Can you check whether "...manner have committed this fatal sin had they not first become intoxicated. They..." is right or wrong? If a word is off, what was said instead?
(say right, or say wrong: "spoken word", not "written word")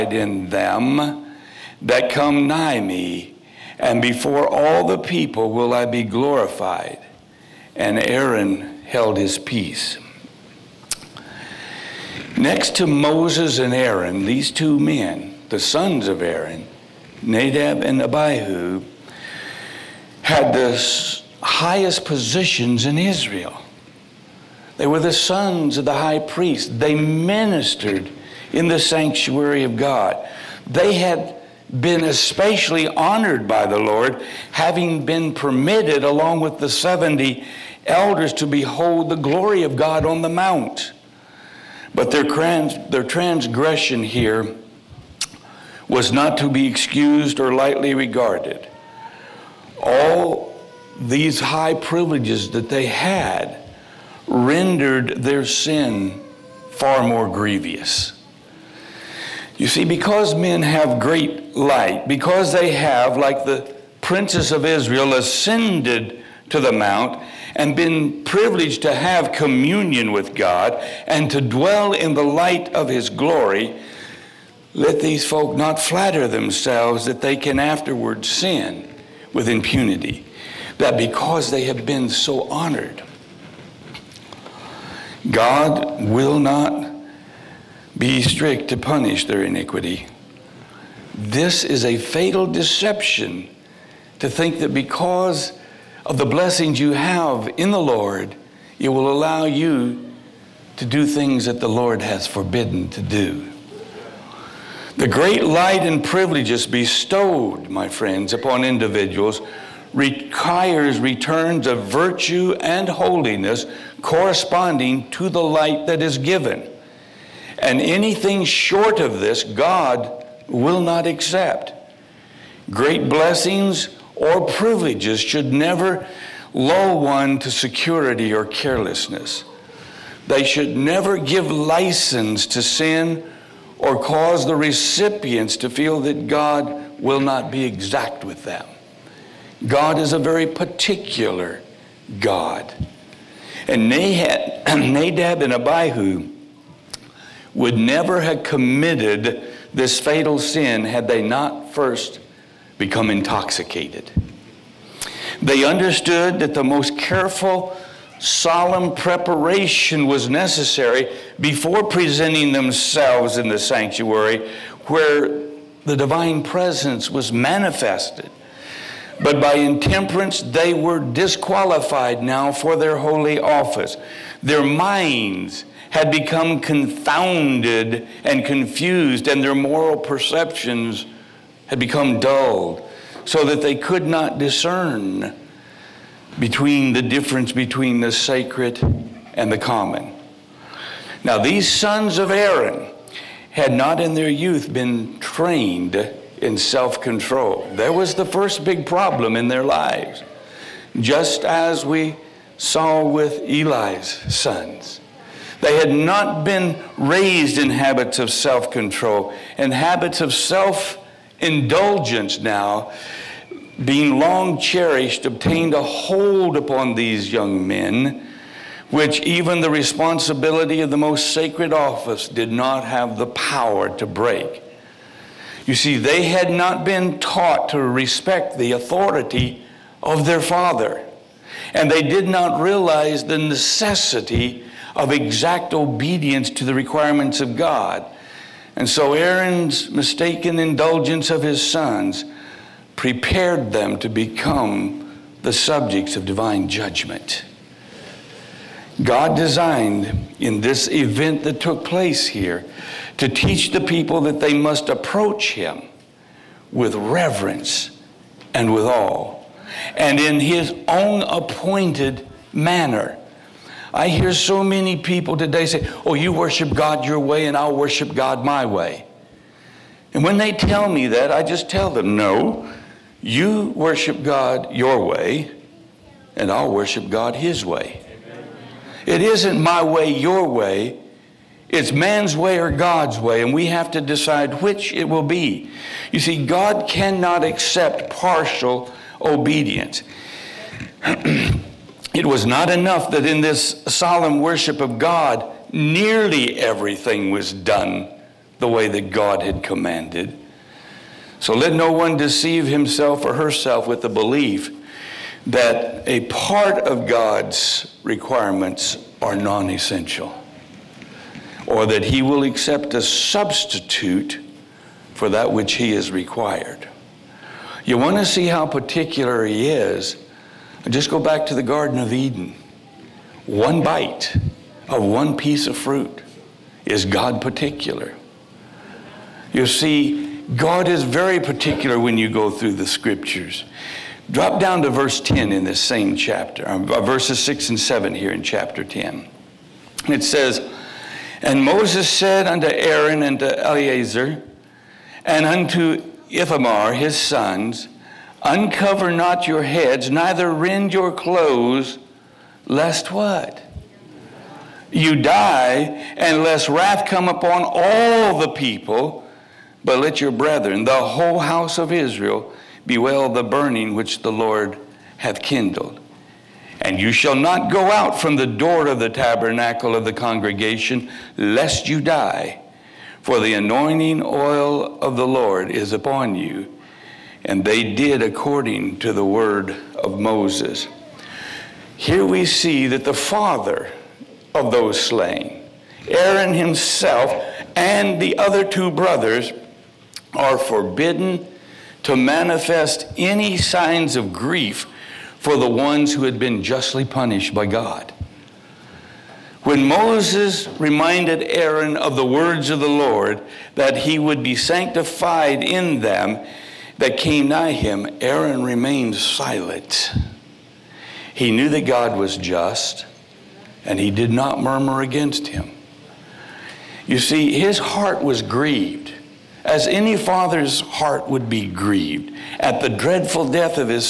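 wrong: "never", not "manner".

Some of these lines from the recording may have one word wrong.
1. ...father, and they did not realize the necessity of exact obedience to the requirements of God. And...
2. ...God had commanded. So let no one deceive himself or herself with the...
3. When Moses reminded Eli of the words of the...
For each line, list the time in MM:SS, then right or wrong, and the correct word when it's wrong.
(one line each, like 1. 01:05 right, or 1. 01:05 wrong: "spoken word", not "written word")
1. 03:50 right
2. 04:59 right
3. 06:39 wrong: "Aaron", not "Eli".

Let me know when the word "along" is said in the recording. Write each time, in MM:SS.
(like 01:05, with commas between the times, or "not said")
00:36.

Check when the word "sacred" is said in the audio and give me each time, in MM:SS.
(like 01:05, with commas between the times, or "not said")
03:08, 03:41.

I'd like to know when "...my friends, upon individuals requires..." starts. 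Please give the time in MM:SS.
01:47.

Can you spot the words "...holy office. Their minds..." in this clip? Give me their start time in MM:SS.
02:52.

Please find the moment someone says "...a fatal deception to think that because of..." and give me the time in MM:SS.
01:31.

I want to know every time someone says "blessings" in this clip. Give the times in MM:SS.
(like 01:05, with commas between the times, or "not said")
01:36, 02:03.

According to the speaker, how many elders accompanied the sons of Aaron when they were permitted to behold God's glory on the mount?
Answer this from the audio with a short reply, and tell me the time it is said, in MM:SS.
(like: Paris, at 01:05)
70, at 00:36.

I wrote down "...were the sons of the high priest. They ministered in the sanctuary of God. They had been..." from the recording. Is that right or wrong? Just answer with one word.
right.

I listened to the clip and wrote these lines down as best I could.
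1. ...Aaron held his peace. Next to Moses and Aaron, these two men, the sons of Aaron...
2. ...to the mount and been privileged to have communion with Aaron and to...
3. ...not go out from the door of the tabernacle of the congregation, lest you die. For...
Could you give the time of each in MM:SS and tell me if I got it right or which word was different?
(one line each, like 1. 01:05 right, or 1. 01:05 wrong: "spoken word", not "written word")
1. 00:08 right
2. 01:06 wrong: "God", not "Aaron"
3. 06:07 right.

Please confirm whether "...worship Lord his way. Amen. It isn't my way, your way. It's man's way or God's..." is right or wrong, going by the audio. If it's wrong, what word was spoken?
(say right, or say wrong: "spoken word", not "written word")
wrong: "God", not "Lord".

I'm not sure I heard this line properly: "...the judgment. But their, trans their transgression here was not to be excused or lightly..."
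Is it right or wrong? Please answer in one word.
wrong.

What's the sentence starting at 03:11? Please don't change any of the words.
Now, these sons of Aaron had not in their youth been trained in self control.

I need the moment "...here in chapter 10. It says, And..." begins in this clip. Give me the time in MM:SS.
05:38.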